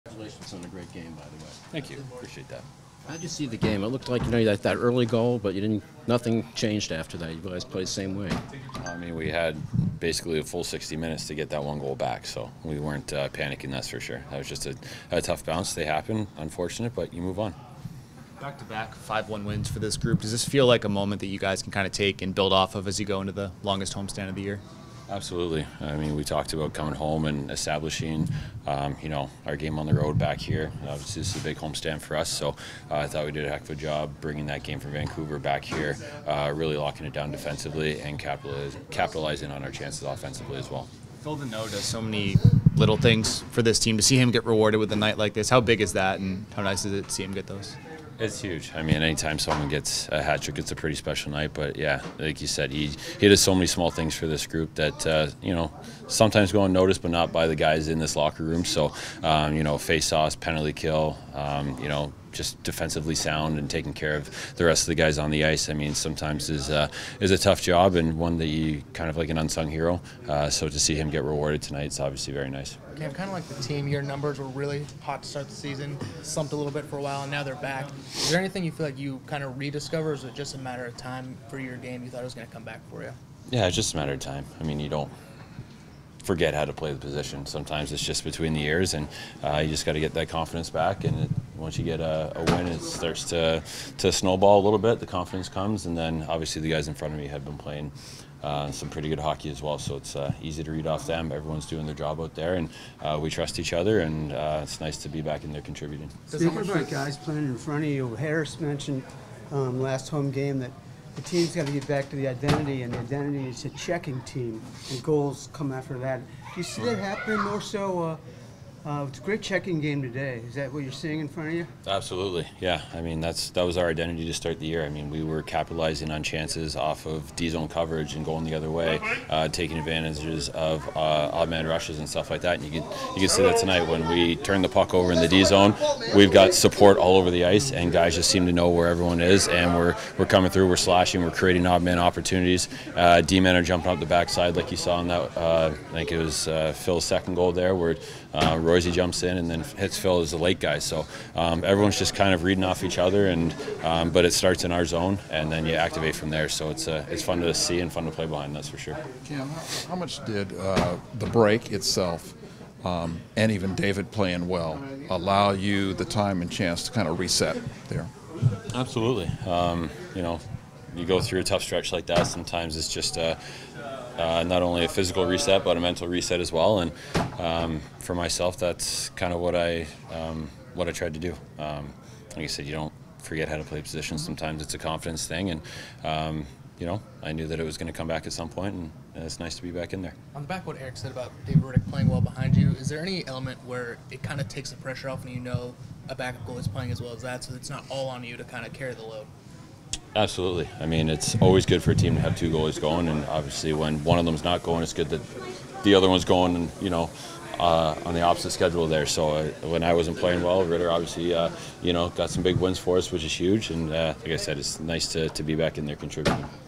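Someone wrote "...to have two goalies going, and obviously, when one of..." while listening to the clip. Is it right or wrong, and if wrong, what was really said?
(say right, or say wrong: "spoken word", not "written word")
right.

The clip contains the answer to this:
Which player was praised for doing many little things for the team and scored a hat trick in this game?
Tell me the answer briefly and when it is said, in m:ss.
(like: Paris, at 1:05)
Phil Danault, at 0:41.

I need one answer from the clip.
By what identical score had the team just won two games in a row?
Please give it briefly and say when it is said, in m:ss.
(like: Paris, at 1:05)
5-1, at 0:18.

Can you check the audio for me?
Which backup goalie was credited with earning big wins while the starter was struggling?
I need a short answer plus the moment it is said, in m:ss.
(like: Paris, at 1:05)
Dave Rittich, at 3:11.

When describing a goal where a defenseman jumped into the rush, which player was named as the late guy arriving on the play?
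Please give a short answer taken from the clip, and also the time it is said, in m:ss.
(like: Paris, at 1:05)
Hitzfeld, at 2:29.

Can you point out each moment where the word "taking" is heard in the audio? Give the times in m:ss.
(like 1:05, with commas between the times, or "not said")
1:03, 2:09.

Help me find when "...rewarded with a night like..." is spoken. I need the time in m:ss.
0:44.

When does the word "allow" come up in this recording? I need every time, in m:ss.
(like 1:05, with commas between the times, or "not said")
2:45.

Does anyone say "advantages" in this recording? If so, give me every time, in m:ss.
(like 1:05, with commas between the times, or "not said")
2:09.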